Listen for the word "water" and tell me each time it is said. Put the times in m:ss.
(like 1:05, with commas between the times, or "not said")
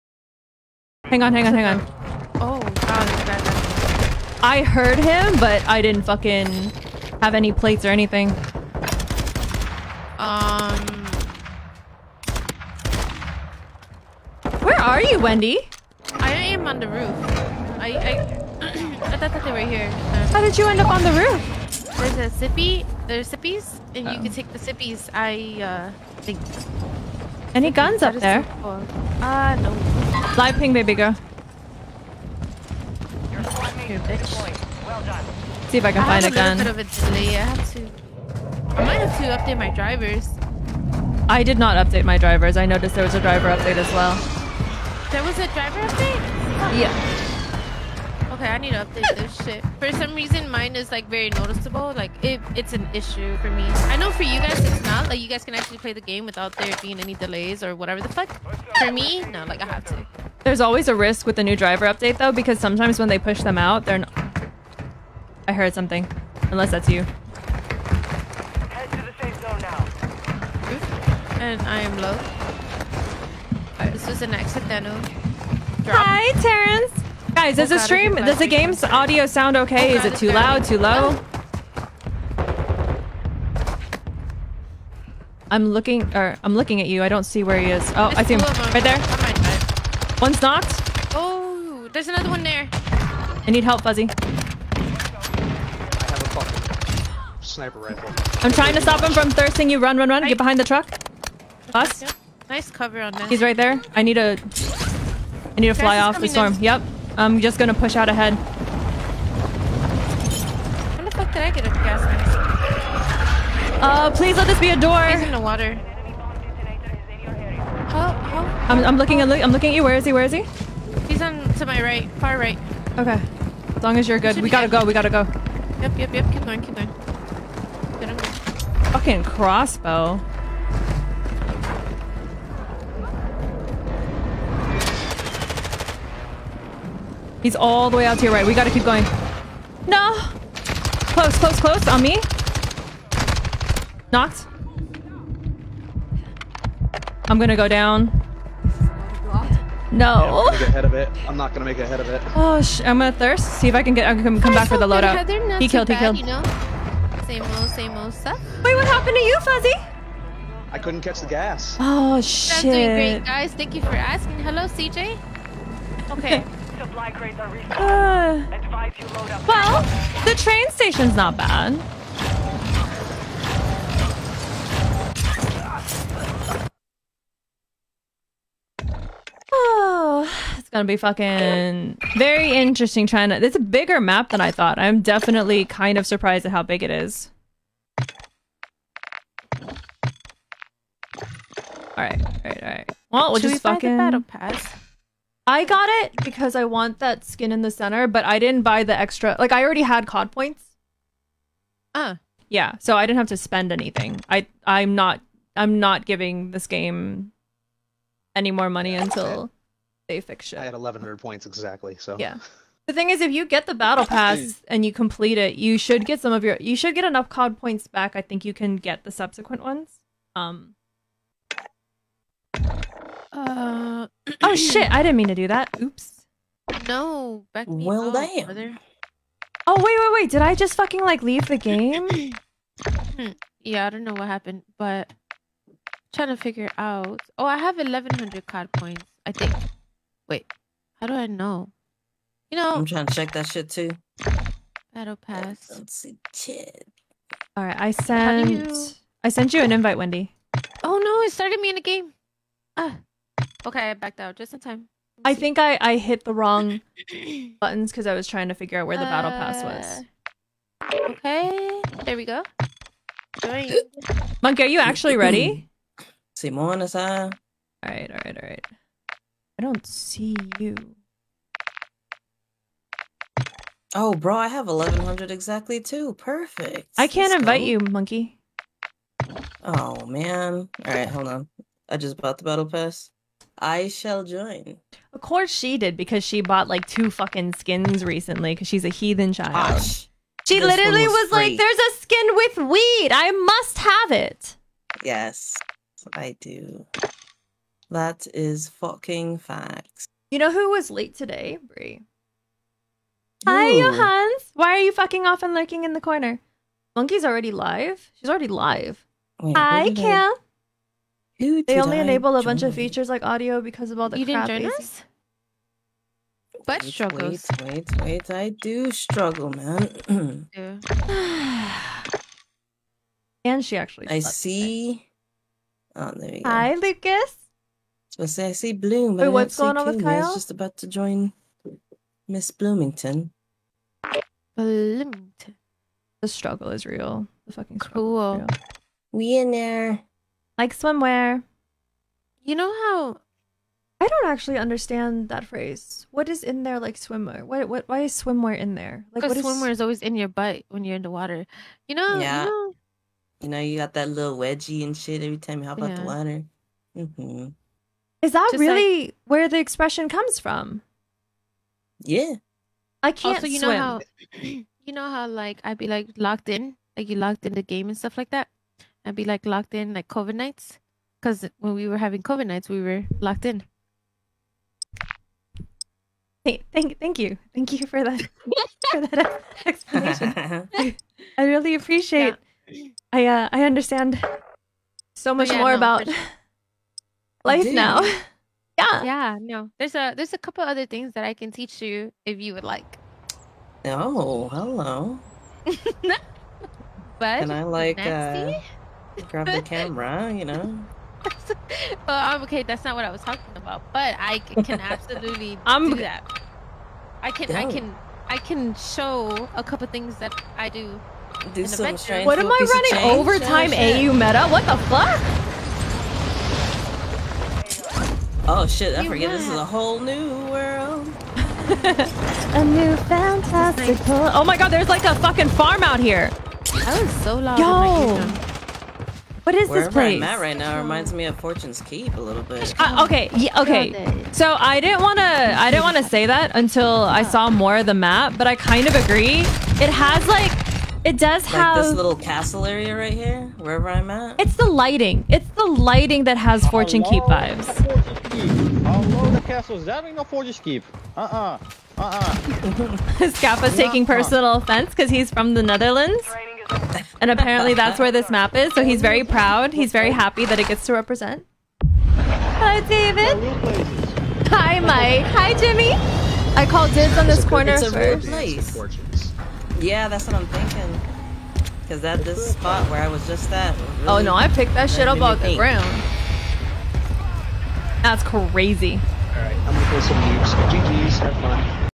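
1:55, 5:51, 5:56.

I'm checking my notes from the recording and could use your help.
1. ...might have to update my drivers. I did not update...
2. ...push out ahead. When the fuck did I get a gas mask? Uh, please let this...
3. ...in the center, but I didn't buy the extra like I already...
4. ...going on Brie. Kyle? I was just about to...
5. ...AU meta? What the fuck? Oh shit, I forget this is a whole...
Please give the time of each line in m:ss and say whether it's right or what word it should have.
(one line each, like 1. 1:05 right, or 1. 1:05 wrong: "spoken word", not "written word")
1. 0:38 right
2. 1:47 right
3. 3:17 right
4. 5:29 wrong: "King", not "Brie"
5. 6:53 right.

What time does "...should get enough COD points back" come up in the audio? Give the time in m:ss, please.
3:36.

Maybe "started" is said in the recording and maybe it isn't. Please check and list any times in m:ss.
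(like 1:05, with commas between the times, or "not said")
4:11.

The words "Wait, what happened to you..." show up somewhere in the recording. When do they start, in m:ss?
2:38.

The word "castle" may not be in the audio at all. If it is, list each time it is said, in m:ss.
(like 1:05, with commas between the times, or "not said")
7:22, 7:29.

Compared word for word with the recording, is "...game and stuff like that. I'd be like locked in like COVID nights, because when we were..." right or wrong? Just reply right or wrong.
right.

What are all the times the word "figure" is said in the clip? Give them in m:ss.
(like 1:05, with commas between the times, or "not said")
3:56, 4:18.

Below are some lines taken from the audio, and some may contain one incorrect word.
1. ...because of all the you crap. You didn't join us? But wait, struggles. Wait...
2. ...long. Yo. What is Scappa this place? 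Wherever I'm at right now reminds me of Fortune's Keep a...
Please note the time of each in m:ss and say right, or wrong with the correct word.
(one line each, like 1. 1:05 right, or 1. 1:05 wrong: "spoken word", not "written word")
1. 5:13 right
2. 7:07 wrong: "Wherever", not "Scappa".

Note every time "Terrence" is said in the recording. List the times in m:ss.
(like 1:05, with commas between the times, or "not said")
1:16.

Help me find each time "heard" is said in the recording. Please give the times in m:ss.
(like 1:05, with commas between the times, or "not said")
0:04, 1:05.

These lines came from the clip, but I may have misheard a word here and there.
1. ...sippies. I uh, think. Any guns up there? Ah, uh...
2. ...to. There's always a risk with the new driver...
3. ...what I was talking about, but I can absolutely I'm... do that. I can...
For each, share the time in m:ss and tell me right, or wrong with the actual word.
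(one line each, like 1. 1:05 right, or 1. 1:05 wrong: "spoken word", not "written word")
1. 0:24 right
2. 0:59 right
3. 6:42 right.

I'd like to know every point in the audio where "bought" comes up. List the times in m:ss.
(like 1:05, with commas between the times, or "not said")
4:42, 4:46.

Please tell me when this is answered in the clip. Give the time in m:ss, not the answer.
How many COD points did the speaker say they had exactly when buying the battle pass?
3:30.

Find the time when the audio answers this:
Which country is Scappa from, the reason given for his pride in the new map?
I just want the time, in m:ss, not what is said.
7:35.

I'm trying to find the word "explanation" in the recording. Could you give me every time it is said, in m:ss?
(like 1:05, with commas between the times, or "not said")
6:19.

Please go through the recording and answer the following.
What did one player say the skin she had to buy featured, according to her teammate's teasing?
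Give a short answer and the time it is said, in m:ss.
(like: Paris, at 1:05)
Weed, at 4:51.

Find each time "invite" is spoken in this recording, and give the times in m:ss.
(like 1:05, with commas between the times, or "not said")
4:09, 4:37.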